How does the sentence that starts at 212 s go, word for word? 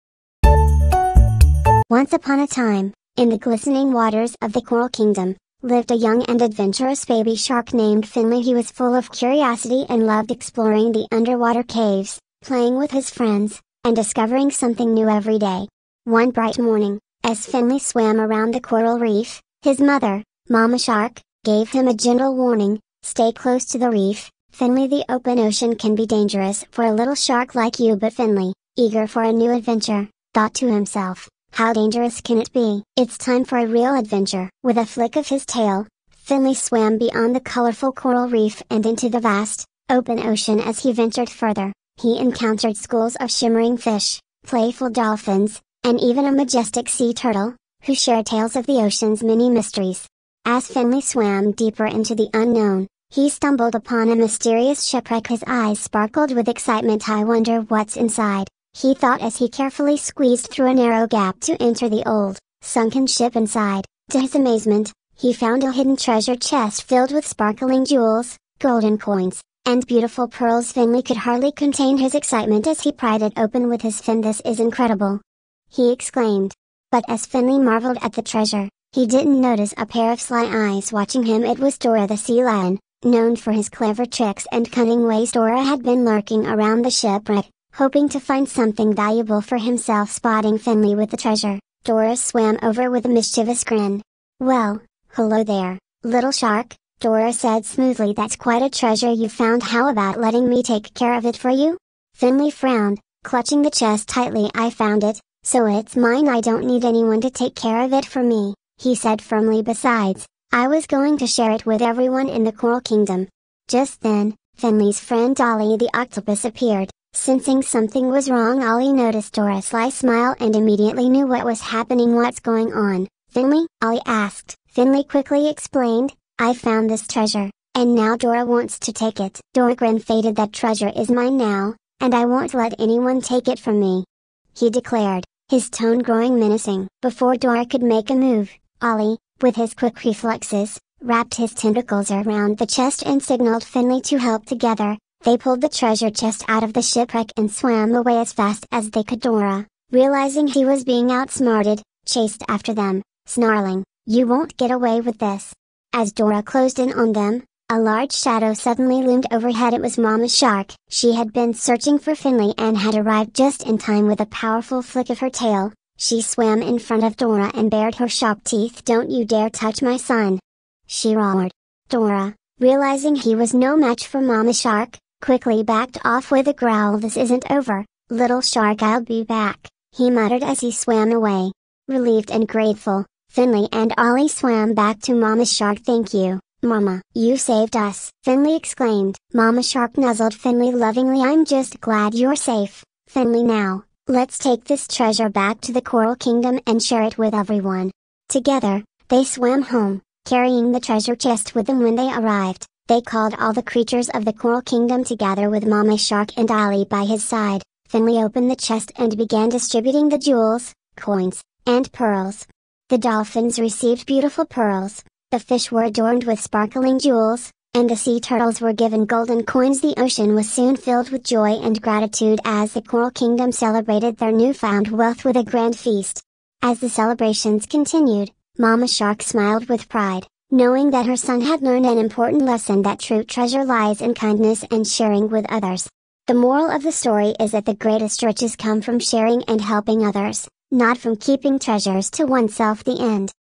The dolphins received beautiful pearls, the fish were adorned with sparkling jewels, and the sea turtles were given golden coins.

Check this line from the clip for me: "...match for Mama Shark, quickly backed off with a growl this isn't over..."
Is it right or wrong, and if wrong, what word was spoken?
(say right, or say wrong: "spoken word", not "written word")
right.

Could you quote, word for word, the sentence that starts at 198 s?
Together, they swam home, carrying the treasure chest with them when they arrived.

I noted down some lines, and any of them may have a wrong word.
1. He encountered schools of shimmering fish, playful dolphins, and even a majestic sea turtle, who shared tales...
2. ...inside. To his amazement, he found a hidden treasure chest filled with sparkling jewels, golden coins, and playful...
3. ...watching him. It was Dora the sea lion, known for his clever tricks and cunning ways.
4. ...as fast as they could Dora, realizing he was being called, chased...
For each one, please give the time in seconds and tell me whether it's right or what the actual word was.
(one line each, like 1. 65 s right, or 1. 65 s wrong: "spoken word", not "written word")
1. 42 s right
2. 63 s wrong: "beautiful", not "playful"
3. 80 s right
4. 148 s wrong: "outsmarted", not "called".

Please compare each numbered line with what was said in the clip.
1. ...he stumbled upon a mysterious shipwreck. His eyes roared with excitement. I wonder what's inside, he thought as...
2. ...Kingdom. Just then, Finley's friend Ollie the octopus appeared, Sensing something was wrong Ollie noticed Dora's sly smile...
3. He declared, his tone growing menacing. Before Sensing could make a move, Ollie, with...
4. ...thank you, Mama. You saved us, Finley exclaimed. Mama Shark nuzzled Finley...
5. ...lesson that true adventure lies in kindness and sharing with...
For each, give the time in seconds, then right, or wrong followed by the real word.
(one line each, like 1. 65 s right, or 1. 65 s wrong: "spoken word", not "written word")
1. 53 s wrong: "sparkled", not "roared"
2. 112 s right
3. 134 s wrong: "Dora", not "Sensing"
4. 185 s right
5. 232 s wrong: "treasure", not "adventure".